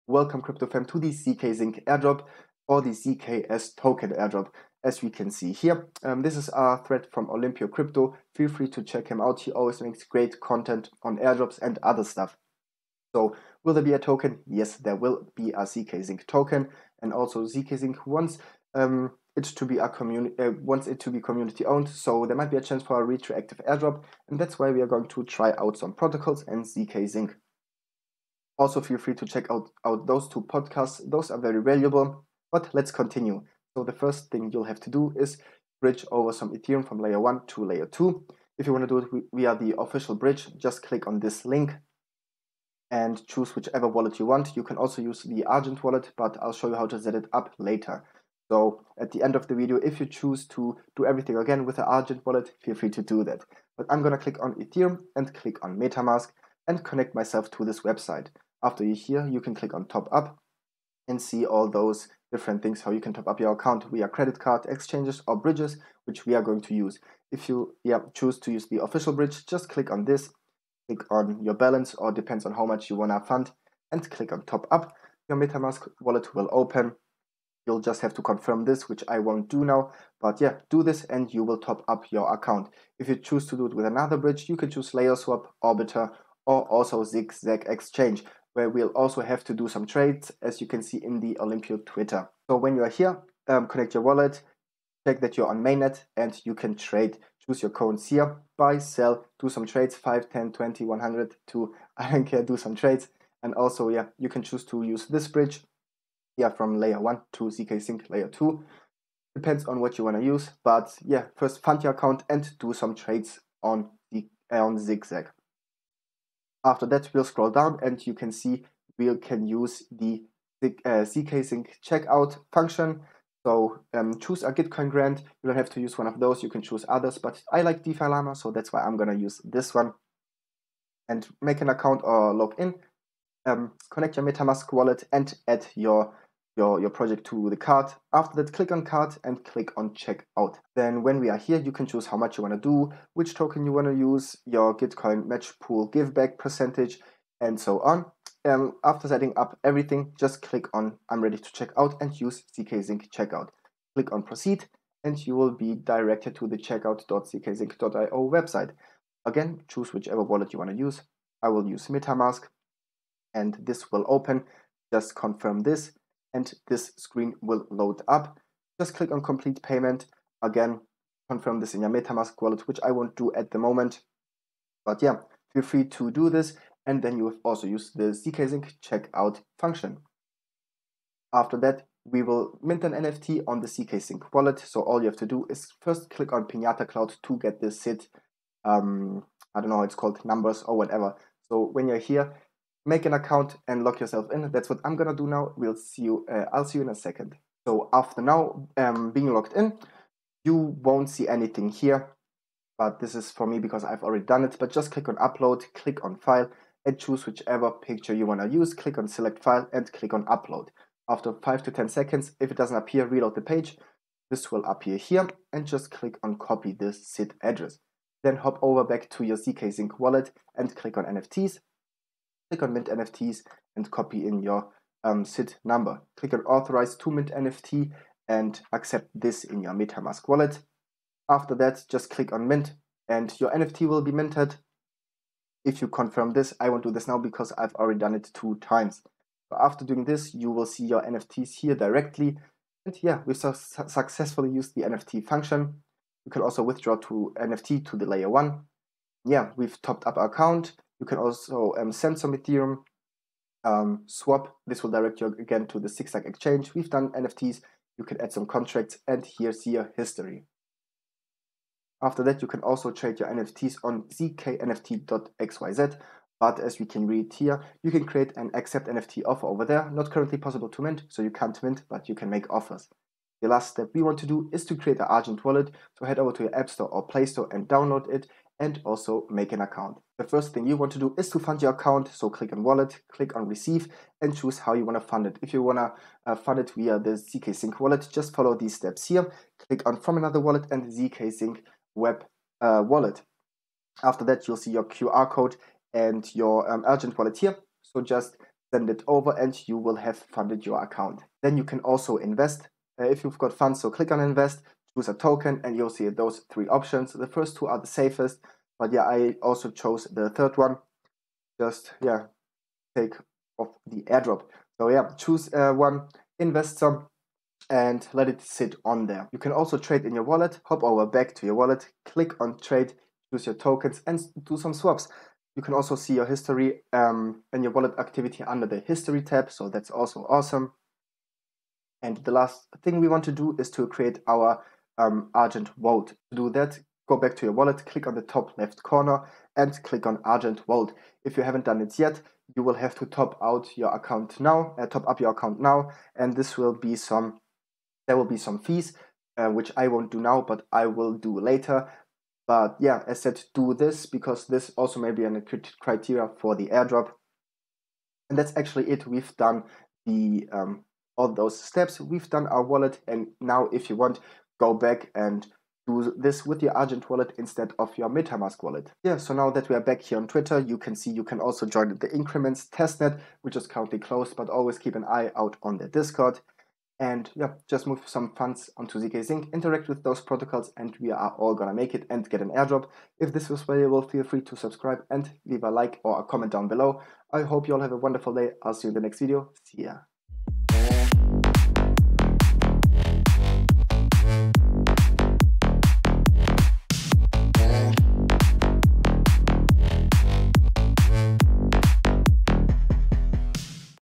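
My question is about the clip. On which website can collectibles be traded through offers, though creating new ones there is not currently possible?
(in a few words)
zknft.xyz.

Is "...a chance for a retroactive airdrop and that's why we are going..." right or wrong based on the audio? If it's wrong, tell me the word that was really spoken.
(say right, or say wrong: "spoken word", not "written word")
right.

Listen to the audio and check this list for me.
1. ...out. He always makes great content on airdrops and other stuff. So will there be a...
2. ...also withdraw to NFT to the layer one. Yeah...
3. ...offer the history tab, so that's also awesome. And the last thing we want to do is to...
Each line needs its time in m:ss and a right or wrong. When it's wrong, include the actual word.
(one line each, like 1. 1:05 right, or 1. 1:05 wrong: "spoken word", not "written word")
1. 0:09 right
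2. 4:06 right
3. 5:28 wrong: "under", not "offer".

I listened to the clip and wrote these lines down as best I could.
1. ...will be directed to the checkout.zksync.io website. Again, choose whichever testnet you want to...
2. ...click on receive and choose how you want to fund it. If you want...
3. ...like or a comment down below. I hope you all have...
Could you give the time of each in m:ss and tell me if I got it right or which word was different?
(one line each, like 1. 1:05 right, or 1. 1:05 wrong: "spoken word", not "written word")
1. 2:35 wrong: "wallet", not "testnet"
2. 4:43 right
3. 6:25 right.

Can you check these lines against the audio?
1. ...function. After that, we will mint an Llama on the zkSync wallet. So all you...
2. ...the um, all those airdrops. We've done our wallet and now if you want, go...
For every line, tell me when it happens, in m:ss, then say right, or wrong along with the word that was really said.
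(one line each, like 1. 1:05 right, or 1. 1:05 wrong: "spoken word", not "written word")
1. 2:59 wrong: "NFT", not "Llama"
2. 6:00 wrong: "steps", not "airdrops".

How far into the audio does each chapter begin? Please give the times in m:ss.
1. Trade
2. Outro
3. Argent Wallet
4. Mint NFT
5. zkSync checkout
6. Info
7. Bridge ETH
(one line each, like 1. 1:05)
1. 1:22
2. 5:57
3. 4:33
4. 3:00
5. 1:55
6. 0:14
7. 0:33.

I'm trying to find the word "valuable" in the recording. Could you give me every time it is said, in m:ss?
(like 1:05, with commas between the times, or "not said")
0:31, 6:23.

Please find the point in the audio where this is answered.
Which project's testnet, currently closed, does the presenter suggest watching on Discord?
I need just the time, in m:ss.
6:12.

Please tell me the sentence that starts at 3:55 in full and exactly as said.
If you confirm this, I won't do this now because I've already done it two times.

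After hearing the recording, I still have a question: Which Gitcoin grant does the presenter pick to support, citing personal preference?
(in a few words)
DeFi Llama.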